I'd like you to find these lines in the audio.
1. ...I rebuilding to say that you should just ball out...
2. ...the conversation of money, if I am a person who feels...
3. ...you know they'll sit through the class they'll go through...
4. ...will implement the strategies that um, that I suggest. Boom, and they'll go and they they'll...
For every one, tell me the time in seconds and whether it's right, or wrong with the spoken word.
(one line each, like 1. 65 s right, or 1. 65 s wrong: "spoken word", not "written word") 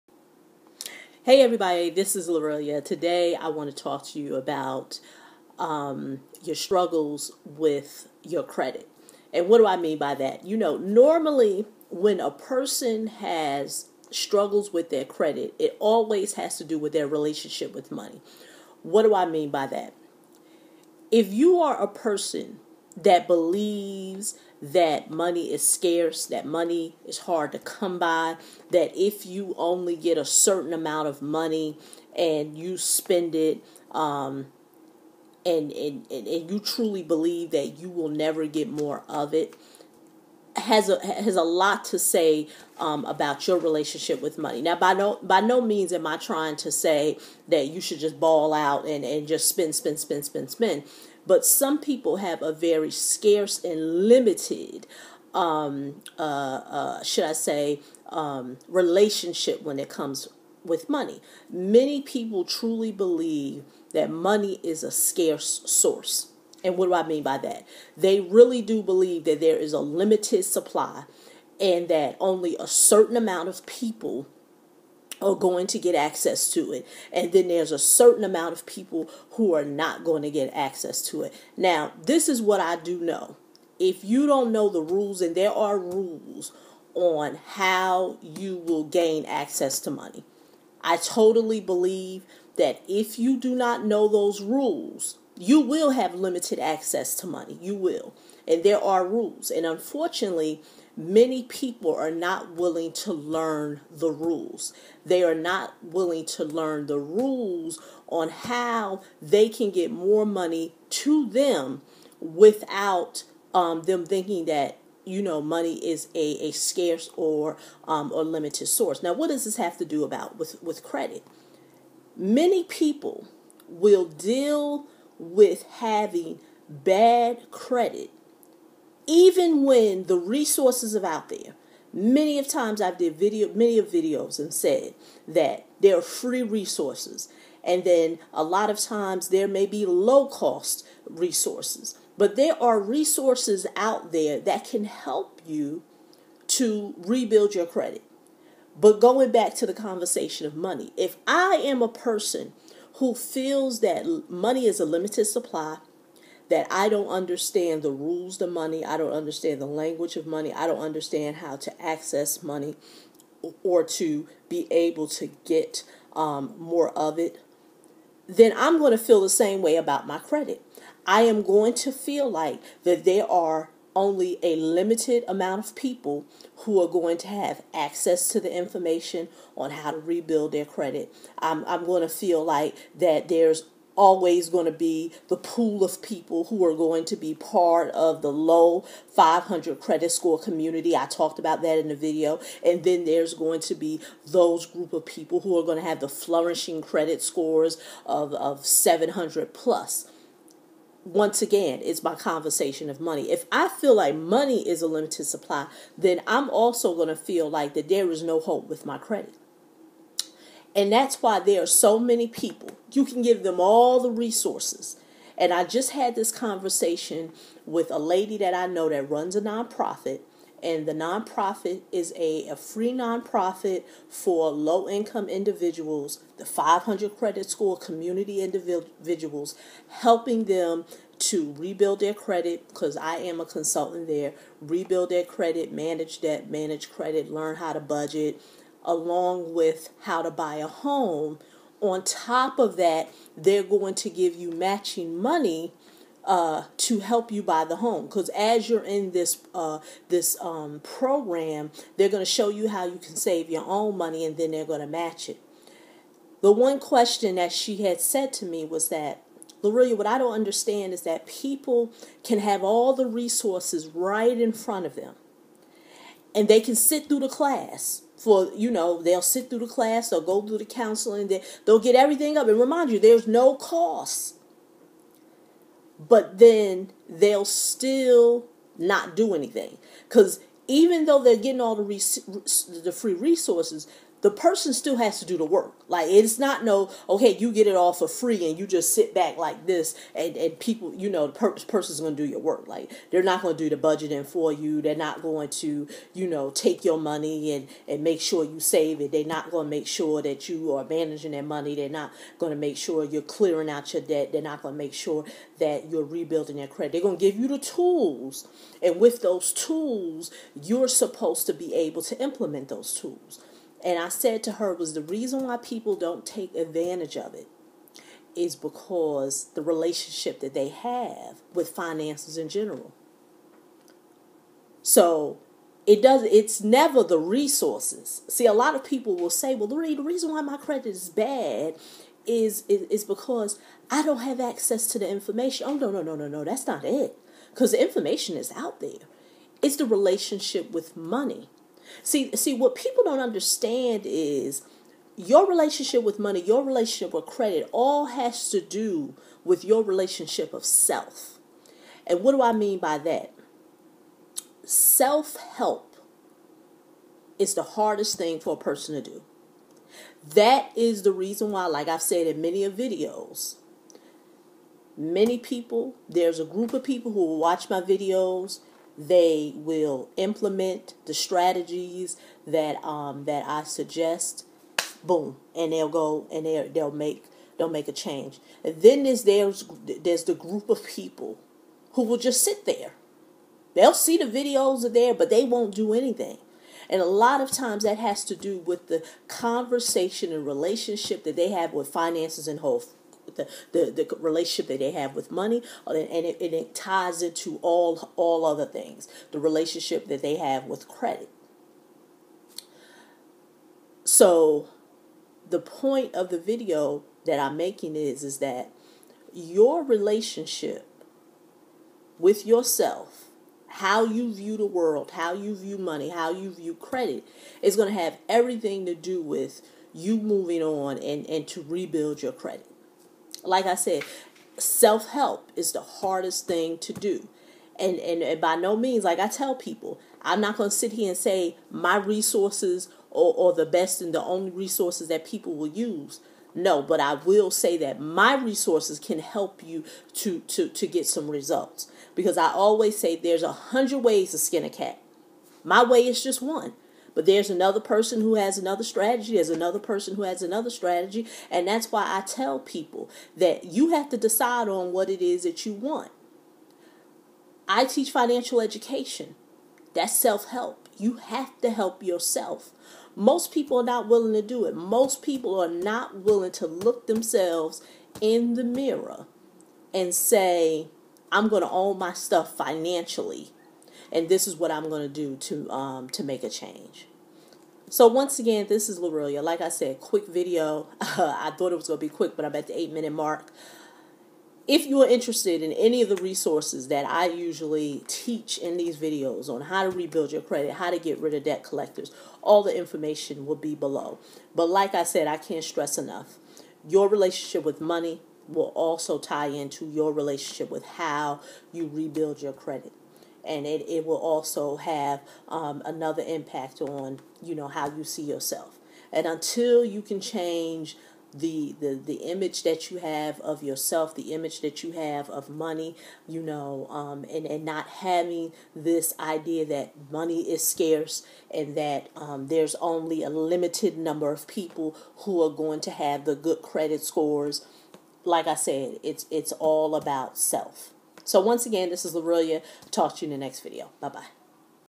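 1. 46 s wrong: "trying", not "rebuilding"
2. 149 s right
3. 268 s right
4. 369 s right.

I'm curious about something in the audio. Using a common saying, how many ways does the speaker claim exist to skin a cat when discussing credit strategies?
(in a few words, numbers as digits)
100.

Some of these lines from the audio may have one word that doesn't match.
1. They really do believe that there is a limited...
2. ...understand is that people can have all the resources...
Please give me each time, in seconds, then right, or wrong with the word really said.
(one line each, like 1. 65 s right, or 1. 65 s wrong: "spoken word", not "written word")
1. 67 s right
2. 260 s right.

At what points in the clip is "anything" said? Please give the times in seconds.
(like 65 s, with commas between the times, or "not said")
279 s, 385 s.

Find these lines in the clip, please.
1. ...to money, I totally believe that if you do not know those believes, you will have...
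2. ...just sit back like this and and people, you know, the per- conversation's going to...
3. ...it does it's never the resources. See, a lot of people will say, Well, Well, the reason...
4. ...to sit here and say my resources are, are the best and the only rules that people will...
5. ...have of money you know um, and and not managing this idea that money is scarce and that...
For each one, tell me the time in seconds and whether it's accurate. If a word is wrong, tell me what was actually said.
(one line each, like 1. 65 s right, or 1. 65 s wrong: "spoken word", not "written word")
1. 89 s wrong: "rules", not "believes"
2. 288 s wrong: "person", not "conversation"
3. 325 s wrong: "Lori", not "Well"
4. 430 s wrong: "resources", not "rules"
5. 514 s wrong: "having", not "managing".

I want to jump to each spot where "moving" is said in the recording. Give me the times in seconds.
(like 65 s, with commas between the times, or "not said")
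420 s.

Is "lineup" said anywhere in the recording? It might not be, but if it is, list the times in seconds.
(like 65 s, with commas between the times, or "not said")
not said.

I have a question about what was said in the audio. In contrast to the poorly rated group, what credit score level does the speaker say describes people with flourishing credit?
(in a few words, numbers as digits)
700 plus.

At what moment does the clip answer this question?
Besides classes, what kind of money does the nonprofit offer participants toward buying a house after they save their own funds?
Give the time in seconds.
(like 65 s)
244 s.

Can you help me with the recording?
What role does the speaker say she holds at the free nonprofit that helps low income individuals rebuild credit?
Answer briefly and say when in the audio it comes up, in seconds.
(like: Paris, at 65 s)
consultant, at 232 s.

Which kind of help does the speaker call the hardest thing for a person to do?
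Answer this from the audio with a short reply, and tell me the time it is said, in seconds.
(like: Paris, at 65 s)
Self-help, at 354 s.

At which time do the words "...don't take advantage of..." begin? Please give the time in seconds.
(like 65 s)
315 s.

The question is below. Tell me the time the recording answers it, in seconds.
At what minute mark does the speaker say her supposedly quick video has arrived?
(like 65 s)
482 s.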